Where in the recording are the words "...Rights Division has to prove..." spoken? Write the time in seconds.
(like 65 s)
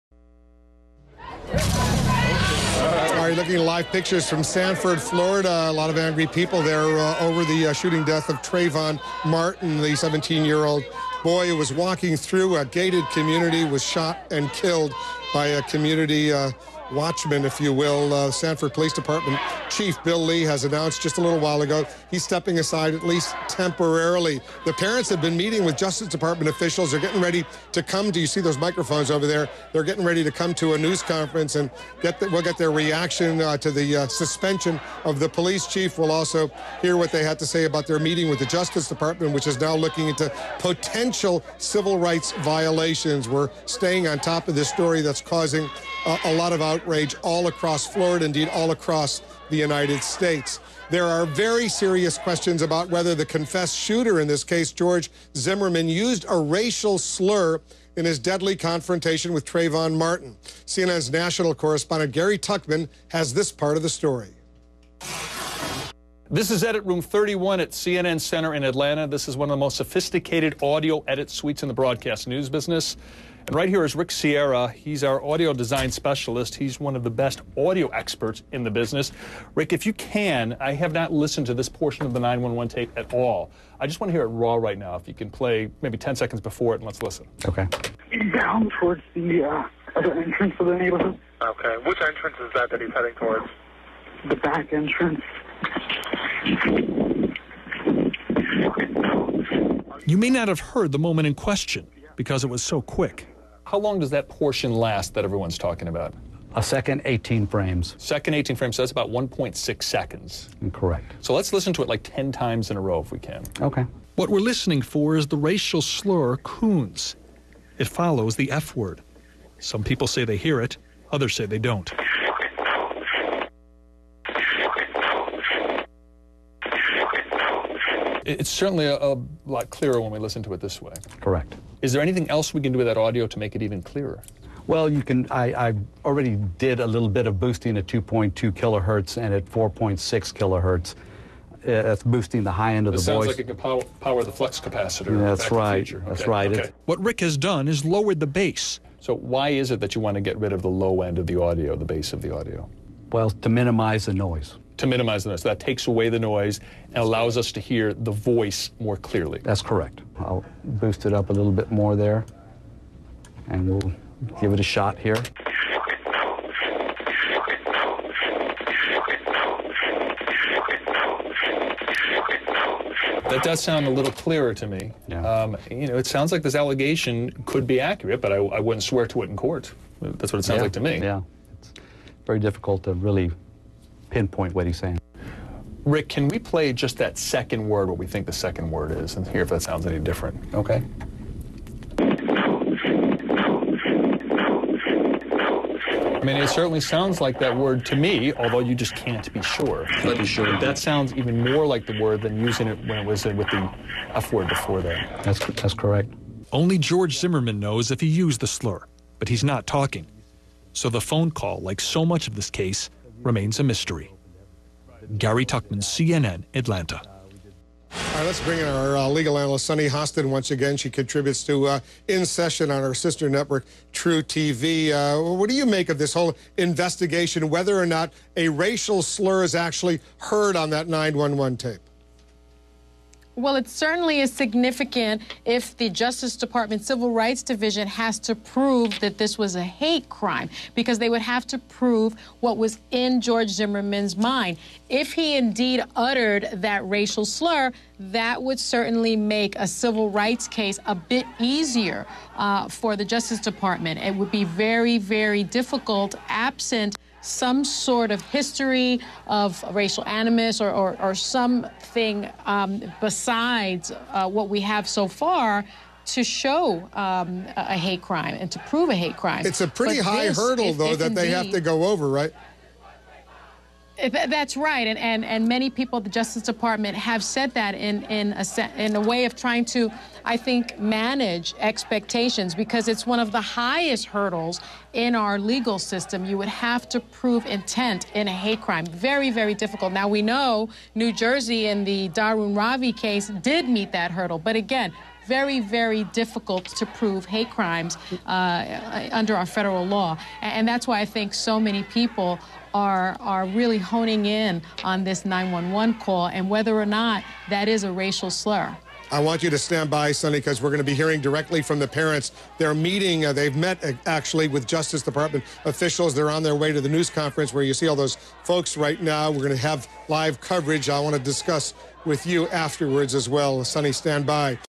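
237 s.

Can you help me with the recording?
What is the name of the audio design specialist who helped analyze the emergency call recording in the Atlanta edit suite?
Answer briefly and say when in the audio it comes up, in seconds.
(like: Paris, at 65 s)
Rick Sierra, at 73 s.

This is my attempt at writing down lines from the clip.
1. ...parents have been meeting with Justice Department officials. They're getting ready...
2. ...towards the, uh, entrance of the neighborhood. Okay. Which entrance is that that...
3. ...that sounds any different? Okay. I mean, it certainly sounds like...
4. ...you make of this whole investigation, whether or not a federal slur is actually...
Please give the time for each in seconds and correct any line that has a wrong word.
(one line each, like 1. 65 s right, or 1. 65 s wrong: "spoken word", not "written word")
1. 24 s right
2. 88 s right
3. 189 s right
4. 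225 s wrong: "racial", not "federal".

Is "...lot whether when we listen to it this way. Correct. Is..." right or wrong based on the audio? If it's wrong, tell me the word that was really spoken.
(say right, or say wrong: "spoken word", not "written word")
wrong: "clearer", not "whether".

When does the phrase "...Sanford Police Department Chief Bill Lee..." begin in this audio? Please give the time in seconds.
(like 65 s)
18 s.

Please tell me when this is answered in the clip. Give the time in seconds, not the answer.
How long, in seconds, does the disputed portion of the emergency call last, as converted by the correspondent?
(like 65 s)
109 s.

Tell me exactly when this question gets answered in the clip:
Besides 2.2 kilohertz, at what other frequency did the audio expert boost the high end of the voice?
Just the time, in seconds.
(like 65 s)
139 s.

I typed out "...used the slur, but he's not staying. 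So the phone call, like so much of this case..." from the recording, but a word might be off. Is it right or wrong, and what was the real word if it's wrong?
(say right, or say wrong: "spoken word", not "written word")
wrong: "talking", not "staying".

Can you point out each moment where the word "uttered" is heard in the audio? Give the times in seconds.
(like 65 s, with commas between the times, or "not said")
245 s.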